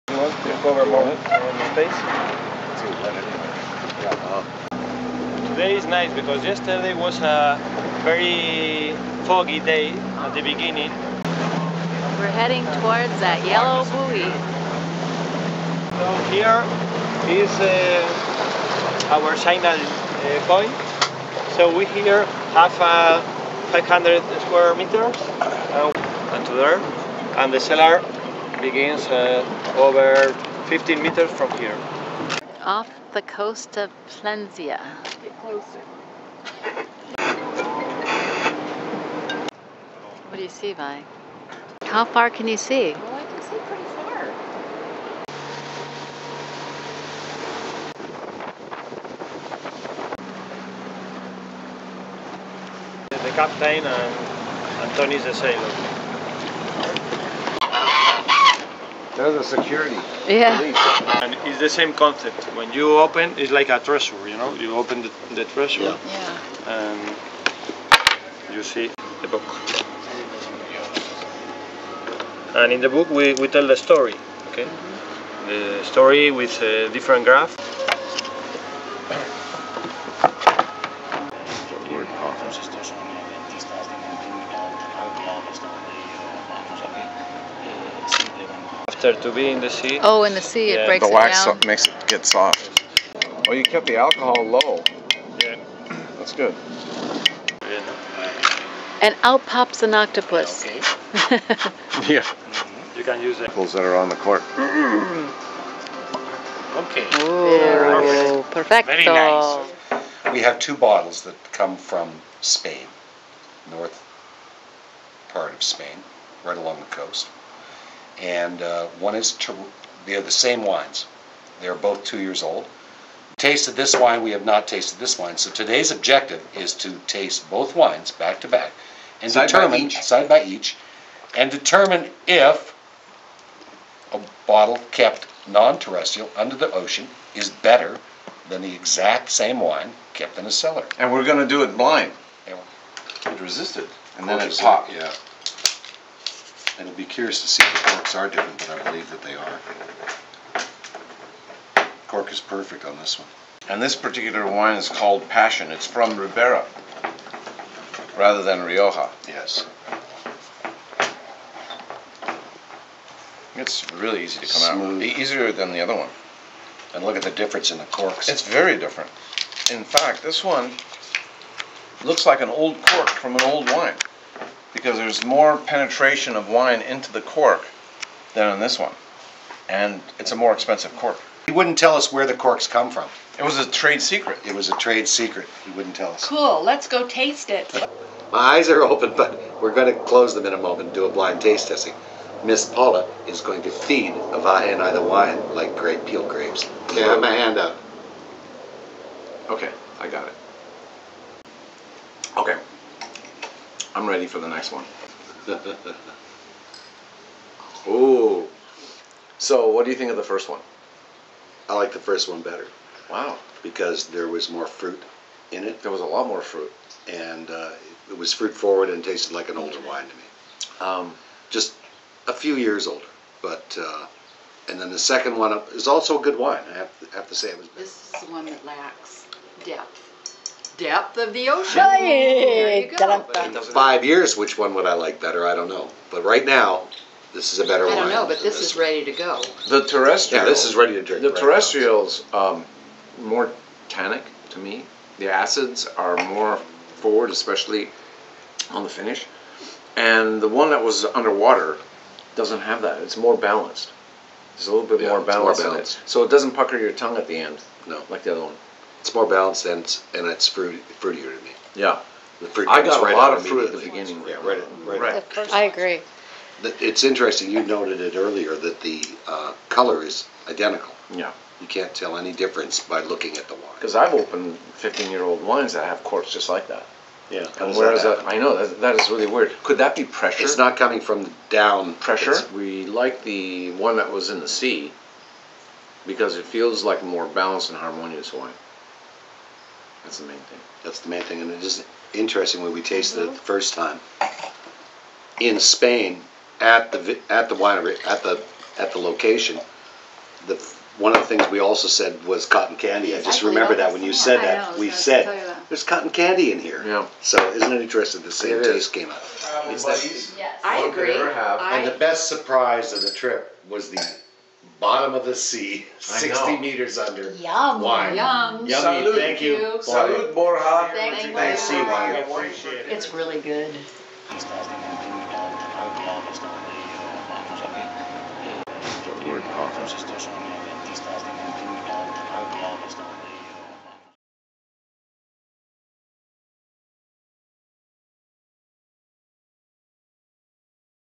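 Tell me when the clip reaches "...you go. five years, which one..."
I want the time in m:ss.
3:52.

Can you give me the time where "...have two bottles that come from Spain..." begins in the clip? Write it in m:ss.
1:50.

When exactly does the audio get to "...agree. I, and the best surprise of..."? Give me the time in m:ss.
5:10.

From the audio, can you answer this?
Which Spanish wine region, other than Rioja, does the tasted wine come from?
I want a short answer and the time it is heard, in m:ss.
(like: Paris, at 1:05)
Ribera, at 2:36.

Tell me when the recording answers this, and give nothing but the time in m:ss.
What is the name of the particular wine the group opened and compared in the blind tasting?
2:35.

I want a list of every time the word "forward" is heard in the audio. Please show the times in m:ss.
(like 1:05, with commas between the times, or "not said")
3:38, 4:06.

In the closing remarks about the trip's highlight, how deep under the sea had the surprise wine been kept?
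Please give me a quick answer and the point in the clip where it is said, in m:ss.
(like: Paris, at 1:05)
60 meters, at 5:15.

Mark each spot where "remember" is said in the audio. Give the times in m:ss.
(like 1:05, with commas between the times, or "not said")
5:03.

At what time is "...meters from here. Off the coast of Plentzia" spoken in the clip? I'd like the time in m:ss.
0:31.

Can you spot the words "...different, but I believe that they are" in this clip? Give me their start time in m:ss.
2:28.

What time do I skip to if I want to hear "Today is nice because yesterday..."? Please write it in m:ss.
0:05.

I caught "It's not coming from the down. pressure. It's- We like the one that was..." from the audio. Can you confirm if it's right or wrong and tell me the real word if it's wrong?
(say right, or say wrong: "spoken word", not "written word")
right.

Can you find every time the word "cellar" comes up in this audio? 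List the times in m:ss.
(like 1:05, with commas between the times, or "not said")
0:27, 2:20.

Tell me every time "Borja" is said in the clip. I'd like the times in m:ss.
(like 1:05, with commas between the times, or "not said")
5:20.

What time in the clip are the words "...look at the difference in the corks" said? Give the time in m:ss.
2:47.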